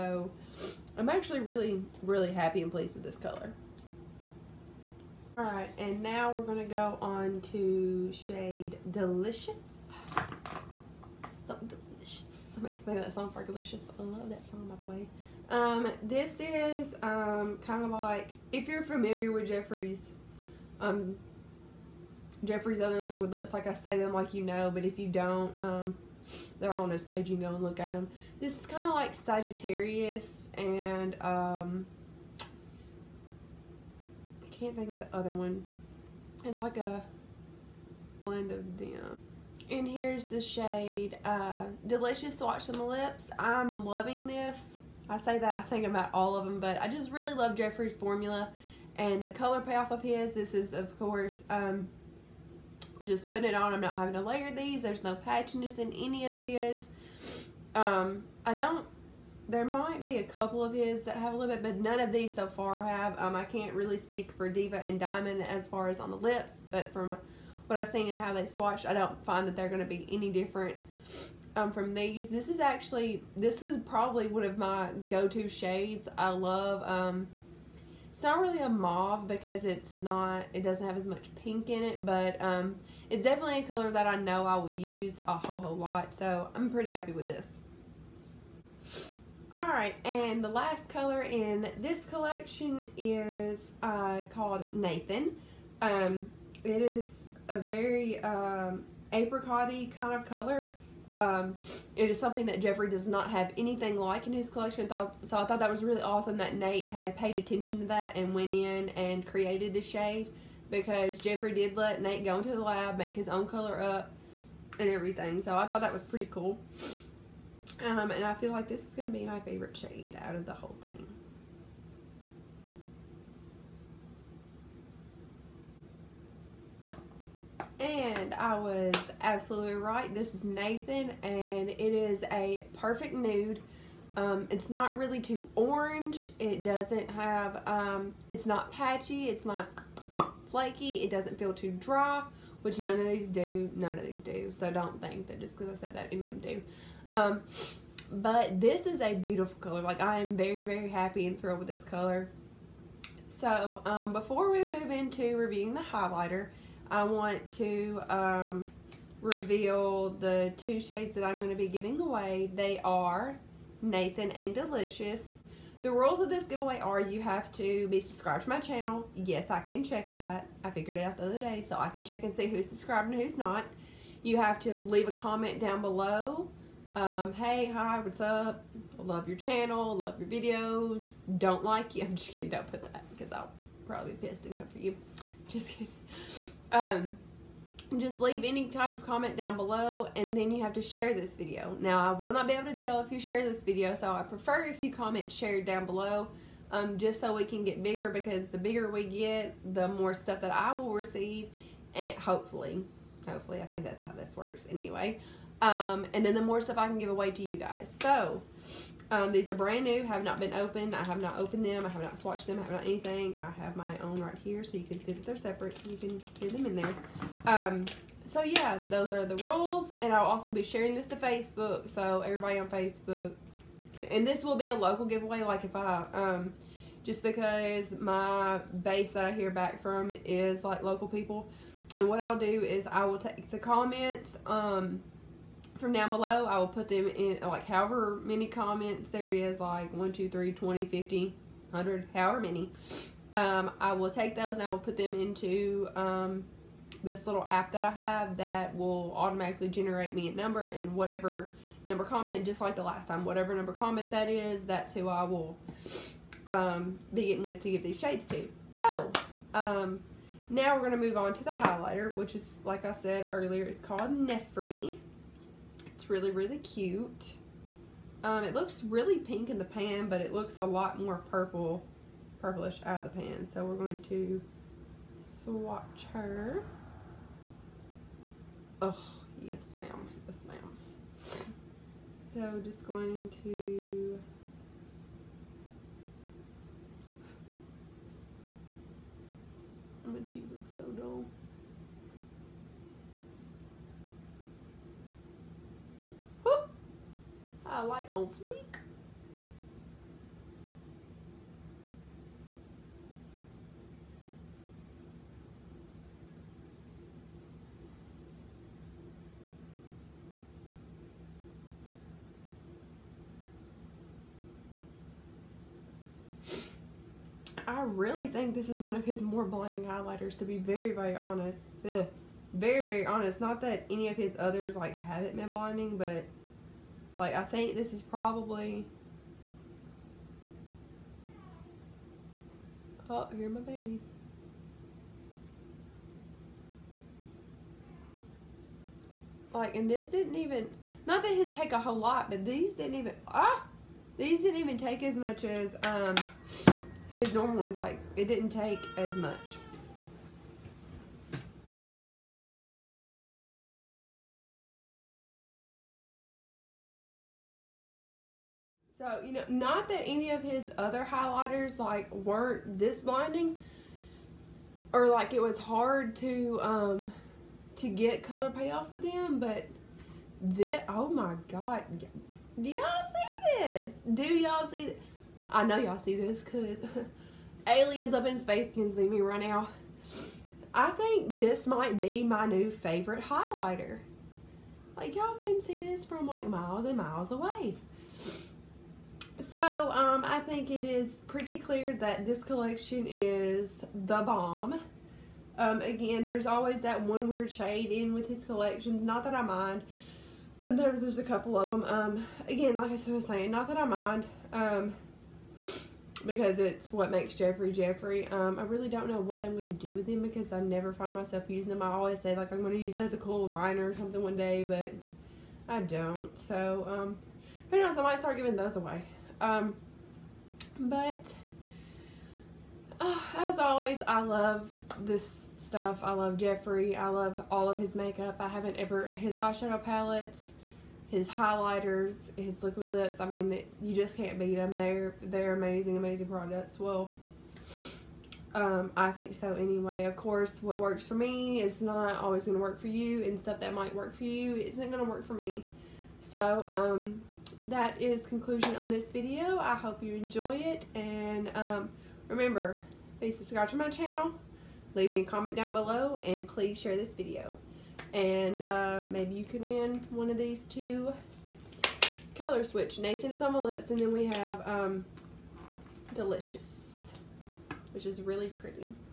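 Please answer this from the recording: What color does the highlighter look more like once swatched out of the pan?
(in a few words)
purple.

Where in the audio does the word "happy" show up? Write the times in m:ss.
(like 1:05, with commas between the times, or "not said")
0:02, 1:26, 2:30.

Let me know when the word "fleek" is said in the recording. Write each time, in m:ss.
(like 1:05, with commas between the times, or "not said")
4:58.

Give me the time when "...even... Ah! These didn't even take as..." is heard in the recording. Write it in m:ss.
5:42.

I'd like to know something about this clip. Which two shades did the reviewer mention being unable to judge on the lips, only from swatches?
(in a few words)
Diva and Diamond.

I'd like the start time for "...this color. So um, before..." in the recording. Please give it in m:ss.
2:31.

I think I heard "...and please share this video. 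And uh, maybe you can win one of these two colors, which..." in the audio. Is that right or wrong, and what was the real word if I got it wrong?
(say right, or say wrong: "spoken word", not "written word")
right.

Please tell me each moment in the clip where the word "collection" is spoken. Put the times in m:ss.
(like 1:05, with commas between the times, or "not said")
1:32, 1:44, 6:32, 6:38.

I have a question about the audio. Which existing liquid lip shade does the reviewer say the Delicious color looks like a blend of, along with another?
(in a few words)
Sagittarius.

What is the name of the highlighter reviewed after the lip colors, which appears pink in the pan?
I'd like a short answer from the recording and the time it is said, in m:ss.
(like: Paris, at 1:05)
Nefri, at 4:24.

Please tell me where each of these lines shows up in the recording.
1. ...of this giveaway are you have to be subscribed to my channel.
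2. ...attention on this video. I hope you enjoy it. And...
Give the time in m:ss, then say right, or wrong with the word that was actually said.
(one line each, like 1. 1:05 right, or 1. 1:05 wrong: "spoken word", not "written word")
1. 2:46 right
2. 7:28 wrong: "conclusion", not "attention".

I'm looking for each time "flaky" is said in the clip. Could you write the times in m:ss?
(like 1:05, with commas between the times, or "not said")
2:20.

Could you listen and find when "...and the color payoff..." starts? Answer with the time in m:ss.
0:48.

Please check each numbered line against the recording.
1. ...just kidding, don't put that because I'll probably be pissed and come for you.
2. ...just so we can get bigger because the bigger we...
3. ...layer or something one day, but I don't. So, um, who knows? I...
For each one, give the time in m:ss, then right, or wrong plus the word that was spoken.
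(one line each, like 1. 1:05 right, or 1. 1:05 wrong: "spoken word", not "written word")
1. 3:02 right
2. 3:16 right
3. 6:53 wrong: "liner", not "layer".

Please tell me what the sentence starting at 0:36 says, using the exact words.
It's like a blend of them.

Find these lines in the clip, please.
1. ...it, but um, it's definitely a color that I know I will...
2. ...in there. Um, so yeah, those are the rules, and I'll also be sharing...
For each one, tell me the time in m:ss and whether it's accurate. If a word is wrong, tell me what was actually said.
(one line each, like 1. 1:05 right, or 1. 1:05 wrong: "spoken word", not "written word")
1. 1:21 right
2. 3:36 right.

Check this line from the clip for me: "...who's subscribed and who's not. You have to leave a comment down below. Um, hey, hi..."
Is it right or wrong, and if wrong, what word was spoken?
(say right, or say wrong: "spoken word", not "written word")
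right.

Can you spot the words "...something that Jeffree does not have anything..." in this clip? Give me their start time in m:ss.
1:42.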